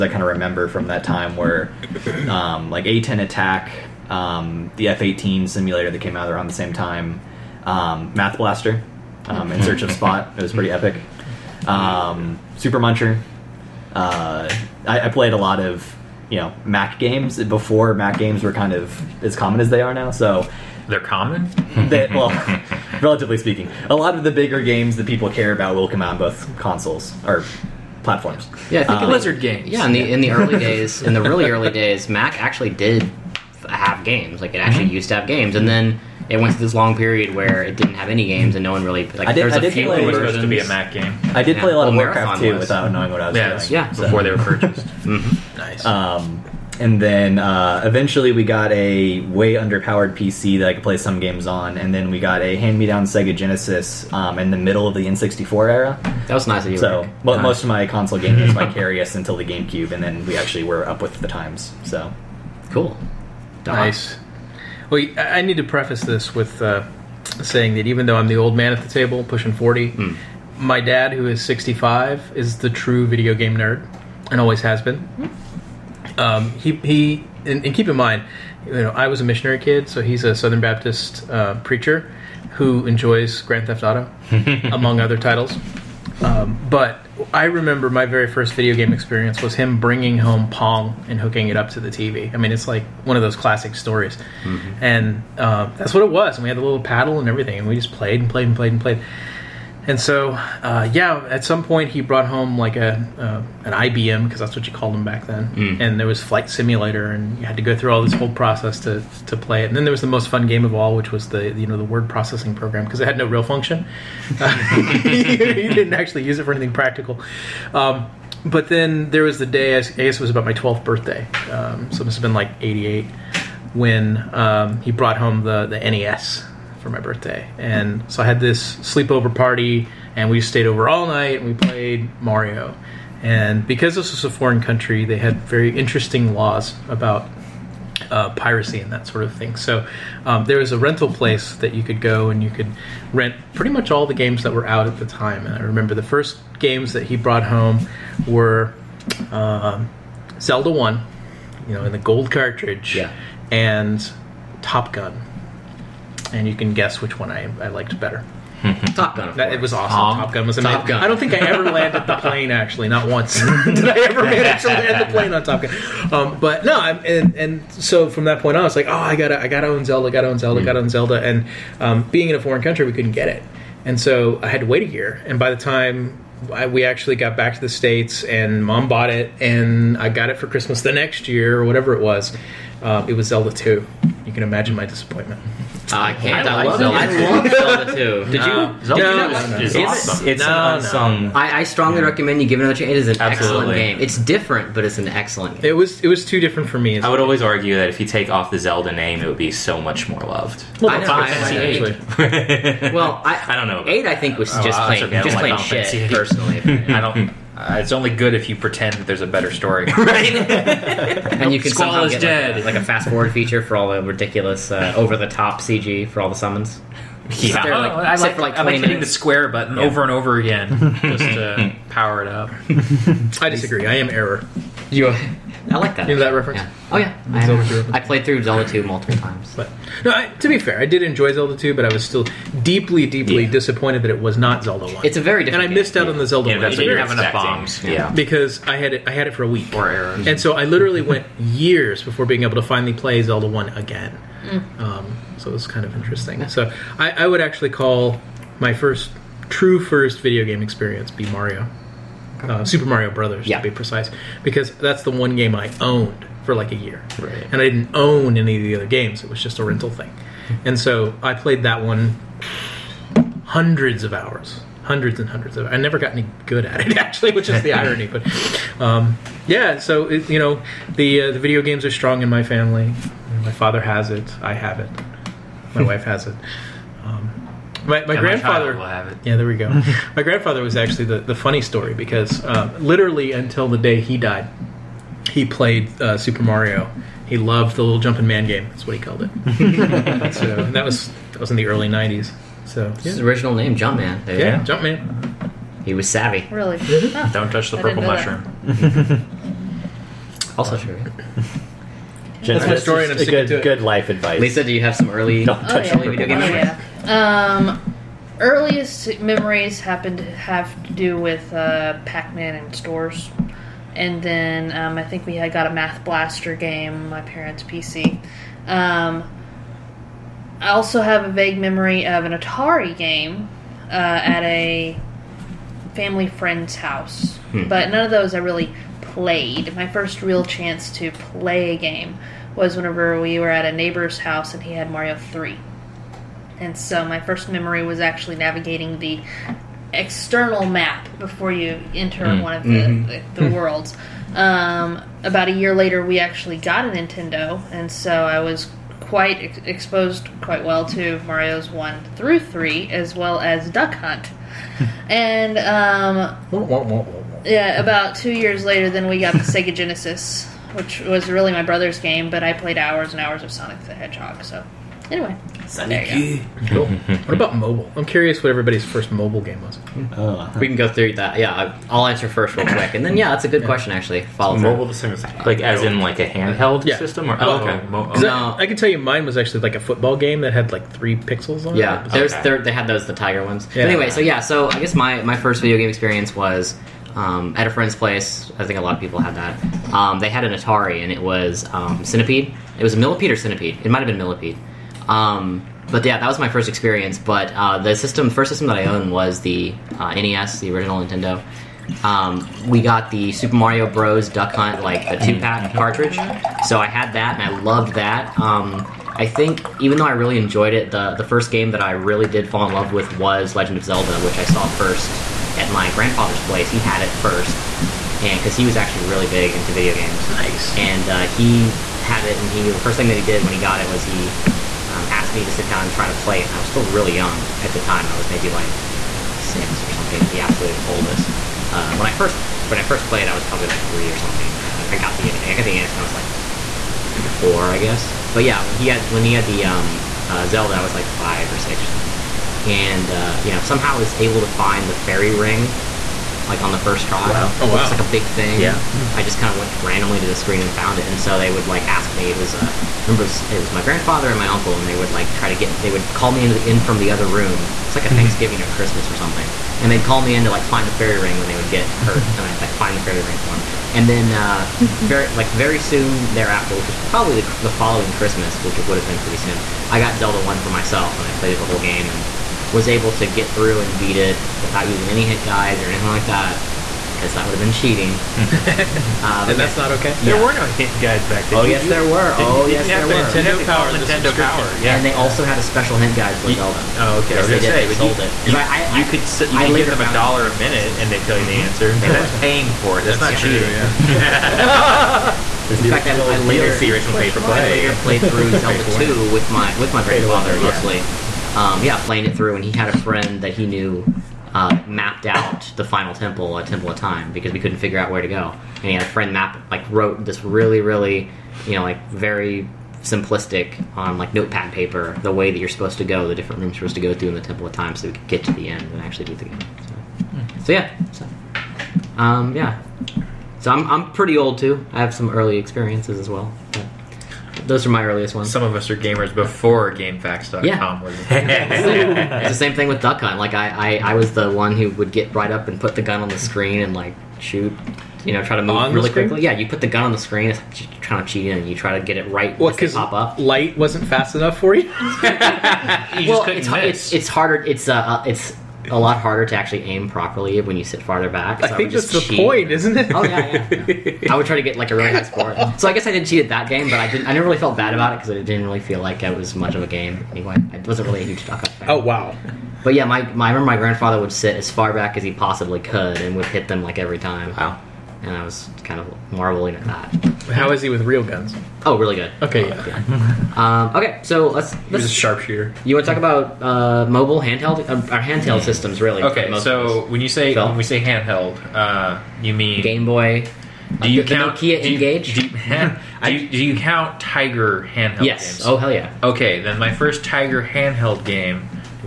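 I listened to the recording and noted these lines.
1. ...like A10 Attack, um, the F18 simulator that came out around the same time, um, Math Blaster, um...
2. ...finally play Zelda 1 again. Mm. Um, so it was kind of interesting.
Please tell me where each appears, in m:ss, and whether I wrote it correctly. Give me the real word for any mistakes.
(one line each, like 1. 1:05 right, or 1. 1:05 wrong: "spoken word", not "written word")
1. 0:02 right
2. 4:02 right.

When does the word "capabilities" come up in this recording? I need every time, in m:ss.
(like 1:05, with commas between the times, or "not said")
not said.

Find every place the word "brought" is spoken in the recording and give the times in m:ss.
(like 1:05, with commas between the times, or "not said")
1:41, 2:04, 2:27.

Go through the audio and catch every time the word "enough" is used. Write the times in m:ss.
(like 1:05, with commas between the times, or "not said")
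3:57, 9:04.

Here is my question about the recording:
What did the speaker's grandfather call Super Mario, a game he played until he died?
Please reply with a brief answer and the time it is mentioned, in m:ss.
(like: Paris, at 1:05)
the little jumping man game, at 4:47.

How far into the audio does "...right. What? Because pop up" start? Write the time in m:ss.
9:02.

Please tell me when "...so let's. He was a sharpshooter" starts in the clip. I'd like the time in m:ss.
9:34.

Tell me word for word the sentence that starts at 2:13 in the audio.
And because this was a foreign country, they had very interesting laws about uh, piracy and that sort of thing.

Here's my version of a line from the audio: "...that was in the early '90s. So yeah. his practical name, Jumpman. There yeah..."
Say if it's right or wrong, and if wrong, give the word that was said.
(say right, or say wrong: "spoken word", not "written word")
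wrong: "original", not "practical".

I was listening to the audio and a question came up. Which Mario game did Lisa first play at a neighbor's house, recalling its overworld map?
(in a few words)
Mario Three.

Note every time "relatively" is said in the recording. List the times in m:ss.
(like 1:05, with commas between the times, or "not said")
0:23.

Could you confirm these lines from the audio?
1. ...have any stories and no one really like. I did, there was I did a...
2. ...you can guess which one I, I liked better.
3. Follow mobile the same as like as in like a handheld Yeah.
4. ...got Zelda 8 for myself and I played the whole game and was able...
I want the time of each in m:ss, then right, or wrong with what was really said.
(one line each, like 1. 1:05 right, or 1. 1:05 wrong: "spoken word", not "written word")
1. 0:37 wrong: "games", not "stories"
2. 2:36 right
3. 6:14 right
4. 7:49 wrong: "1", not "8".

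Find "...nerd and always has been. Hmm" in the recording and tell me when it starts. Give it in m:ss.
1:13.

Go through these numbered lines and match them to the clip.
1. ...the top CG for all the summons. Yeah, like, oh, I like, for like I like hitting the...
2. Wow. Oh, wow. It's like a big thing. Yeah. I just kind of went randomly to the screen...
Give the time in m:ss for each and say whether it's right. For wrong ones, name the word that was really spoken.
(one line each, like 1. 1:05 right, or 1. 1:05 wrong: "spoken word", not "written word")
1. 3:35 right
2. 7:27 right.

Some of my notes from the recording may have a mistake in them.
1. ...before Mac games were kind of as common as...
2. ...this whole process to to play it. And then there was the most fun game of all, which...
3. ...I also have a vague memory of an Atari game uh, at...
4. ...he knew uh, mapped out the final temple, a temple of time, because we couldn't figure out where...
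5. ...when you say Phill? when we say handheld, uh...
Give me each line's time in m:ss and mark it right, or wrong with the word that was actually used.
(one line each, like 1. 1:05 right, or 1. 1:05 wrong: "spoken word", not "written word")
1. 0:17 right
2. 1:48 right
3. 5:20 right
4. 8:23 right
5. 9:40 right.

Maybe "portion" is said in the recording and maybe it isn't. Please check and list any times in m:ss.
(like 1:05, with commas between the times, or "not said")
not said.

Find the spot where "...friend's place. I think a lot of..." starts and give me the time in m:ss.
6:27.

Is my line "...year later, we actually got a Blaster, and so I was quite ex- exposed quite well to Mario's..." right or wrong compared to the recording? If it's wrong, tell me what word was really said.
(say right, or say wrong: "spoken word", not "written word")
wrong: "Nintendo", not "Blaster".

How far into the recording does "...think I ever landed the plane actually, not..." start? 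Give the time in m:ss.
2:41.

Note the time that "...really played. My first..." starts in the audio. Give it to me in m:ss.
5:28.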